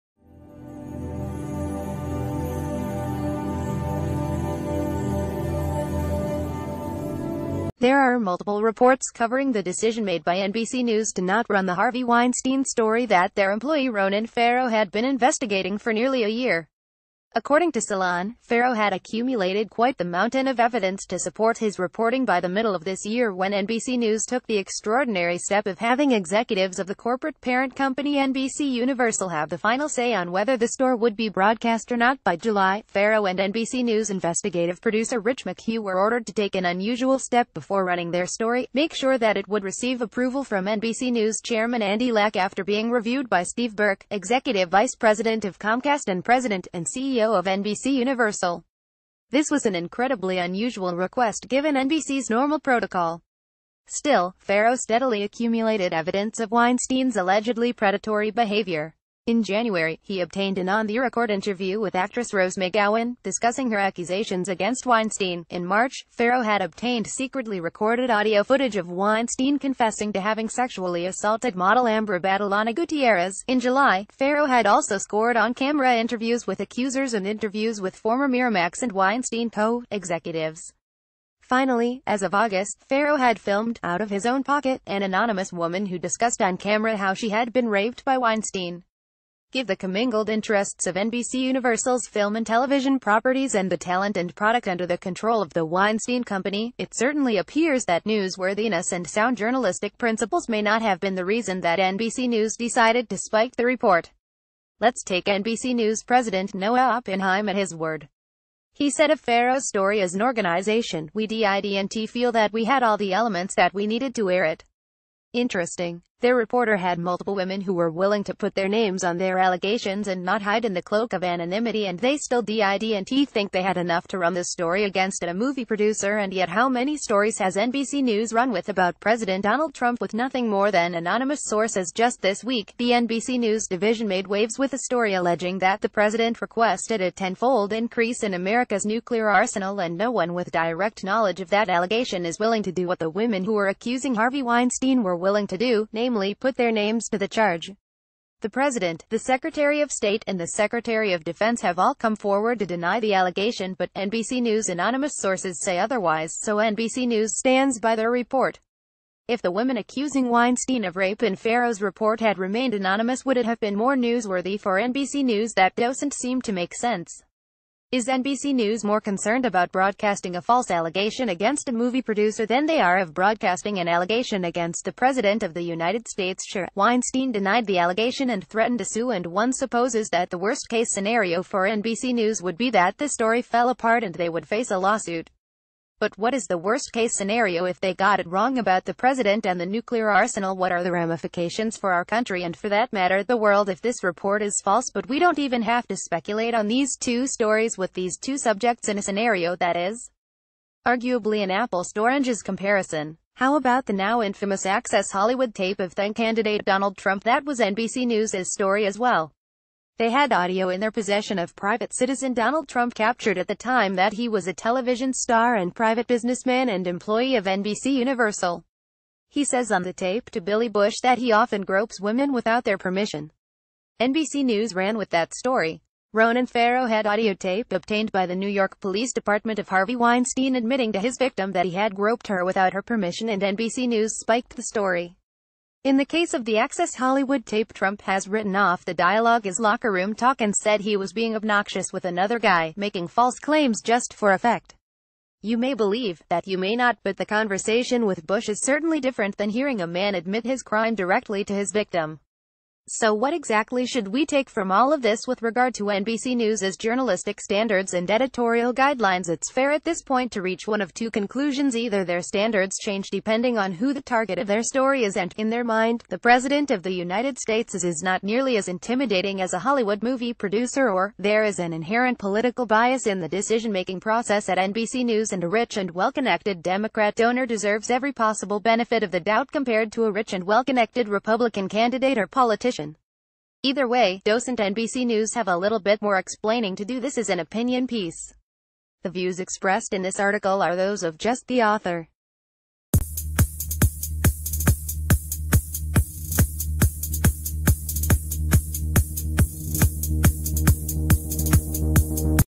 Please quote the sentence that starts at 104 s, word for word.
Let's take NBC News president Noah Oppenheim at his word.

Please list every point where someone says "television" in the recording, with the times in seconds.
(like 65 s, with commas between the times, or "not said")
92 s, 214 s.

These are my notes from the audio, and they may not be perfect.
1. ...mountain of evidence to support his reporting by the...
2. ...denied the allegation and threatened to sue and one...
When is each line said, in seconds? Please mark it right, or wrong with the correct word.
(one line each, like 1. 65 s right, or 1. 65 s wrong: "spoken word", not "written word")
1. 20 s right
2. 177 s right.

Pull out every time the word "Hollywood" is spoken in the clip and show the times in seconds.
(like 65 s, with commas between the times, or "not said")
205 s, 236 s, 269 s.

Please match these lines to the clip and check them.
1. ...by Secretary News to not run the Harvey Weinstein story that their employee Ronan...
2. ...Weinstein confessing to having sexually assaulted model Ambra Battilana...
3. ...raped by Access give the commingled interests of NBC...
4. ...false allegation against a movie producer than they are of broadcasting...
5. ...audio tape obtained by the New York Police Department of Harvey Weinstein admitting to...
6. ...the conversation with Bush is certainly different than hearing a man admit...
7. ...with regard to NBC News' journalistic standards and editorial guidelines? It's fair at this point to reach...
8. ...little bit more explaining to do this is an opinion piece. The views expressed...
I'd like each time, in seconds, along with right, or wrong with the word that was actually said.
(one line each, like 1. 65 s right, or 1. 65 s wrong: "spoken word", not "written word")
1. 10 s wrong: "NBC", not "Secretary"
2. 68 s right
3. 87 s wrong: "Weinstein", not "Access"
4. 170 s right
5. 227 s right
6. 247 s right
7. 255 s right
8. 285 s right.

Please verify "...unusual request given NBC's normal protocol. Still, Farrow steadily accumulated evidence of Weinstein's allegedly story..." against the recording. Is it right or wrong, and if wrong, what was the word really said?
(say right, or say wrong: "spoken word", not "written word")
wrong: "predatory", not "story".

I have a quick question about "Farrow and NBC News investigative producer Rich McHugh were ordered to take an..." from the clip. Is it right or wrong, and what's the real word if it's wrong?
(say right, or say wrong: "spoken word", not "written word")
right.